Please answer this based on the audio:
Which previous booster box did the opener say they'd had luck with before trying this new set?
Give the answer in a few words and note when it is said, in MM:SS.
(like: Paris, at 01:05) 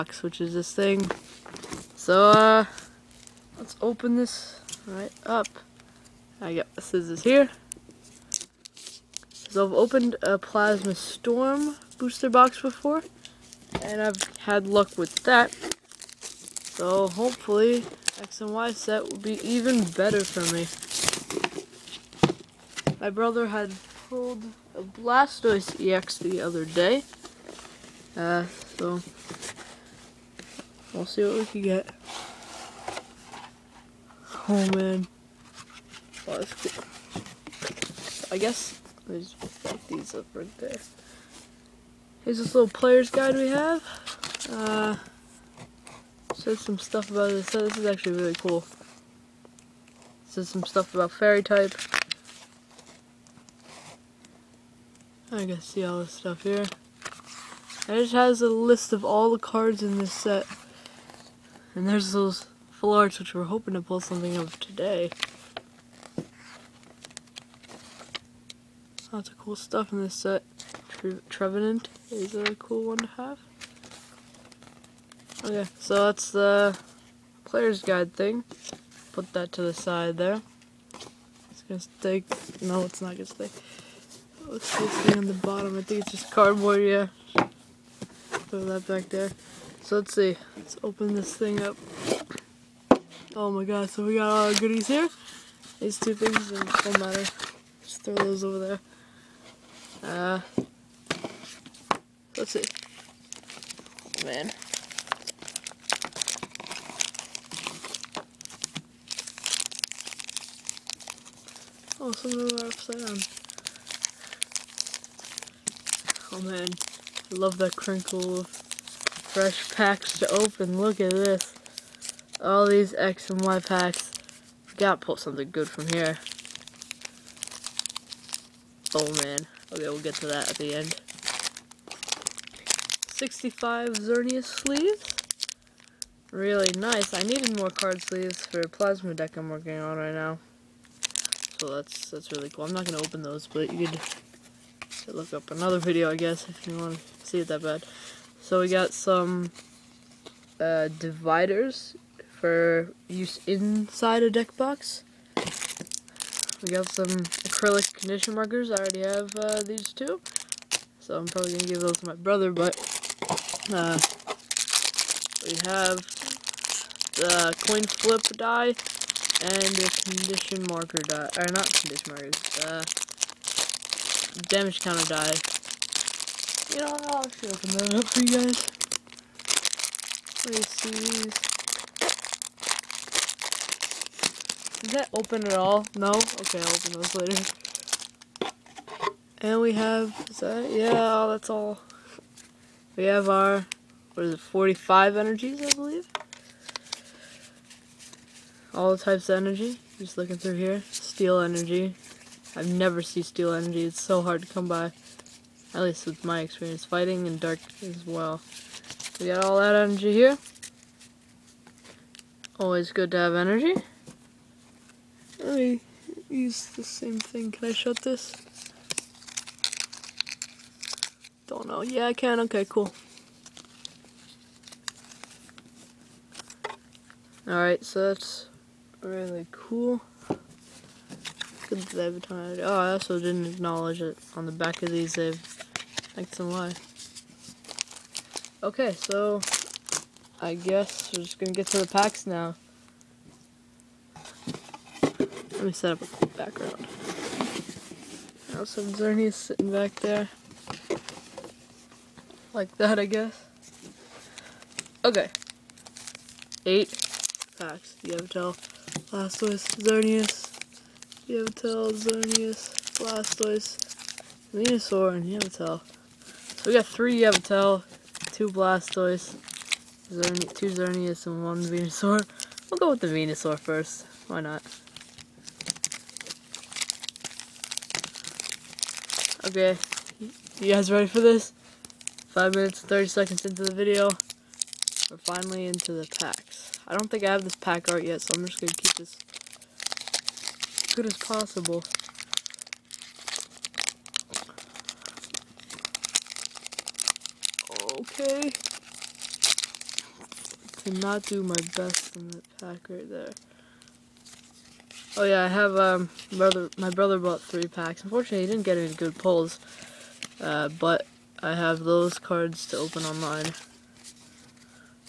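Plasma Storm, at 00:10.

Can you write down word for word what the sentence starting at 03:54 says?
On the back of these, they've thanks and Y.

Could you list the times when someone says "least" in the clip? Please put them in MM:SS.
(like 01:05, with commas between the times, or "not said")
03:25.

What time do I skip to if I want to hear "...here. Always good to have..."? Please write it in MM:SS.
03:30.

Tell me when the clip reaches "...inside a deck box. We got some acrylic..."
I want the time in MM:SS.
02:33.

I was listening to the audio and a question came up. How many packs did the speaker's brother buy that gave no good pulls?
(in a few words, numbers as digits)
3.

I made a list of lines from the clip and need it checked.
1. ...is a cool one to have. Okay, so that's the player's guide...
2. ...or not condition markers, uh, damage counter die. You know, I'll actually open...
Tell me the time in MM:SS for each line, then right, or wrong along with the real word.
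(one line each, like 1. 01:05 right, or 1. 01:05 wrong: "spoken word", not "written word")
1. 01:12 right
2. 02:51 right.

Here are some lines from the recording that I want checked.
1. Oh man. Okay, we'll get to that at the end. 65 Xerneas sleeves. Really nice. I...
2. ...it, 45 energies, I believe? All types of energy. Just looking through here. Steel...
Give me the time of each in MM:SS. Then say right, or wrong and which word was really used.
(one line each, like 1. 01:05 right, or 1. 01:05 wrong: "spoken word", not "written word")
1. 02:08 right
2. 03:14 right.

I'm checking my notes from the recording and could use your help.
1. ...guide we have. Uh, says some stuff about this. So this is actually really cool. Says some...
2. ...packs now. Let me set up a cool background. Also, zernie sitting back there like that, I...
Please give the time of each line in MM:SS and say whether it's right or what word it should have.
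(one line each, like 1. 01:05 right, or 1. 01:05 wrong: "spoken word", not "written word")
1. 00:43 right
2. 04:01 right.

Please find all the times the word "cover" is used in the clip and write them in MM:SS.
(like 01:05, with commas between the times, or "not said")
not said.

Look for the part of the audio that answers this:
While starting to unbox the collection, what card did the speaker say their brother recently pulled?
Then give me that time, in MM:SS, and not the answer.
00:24.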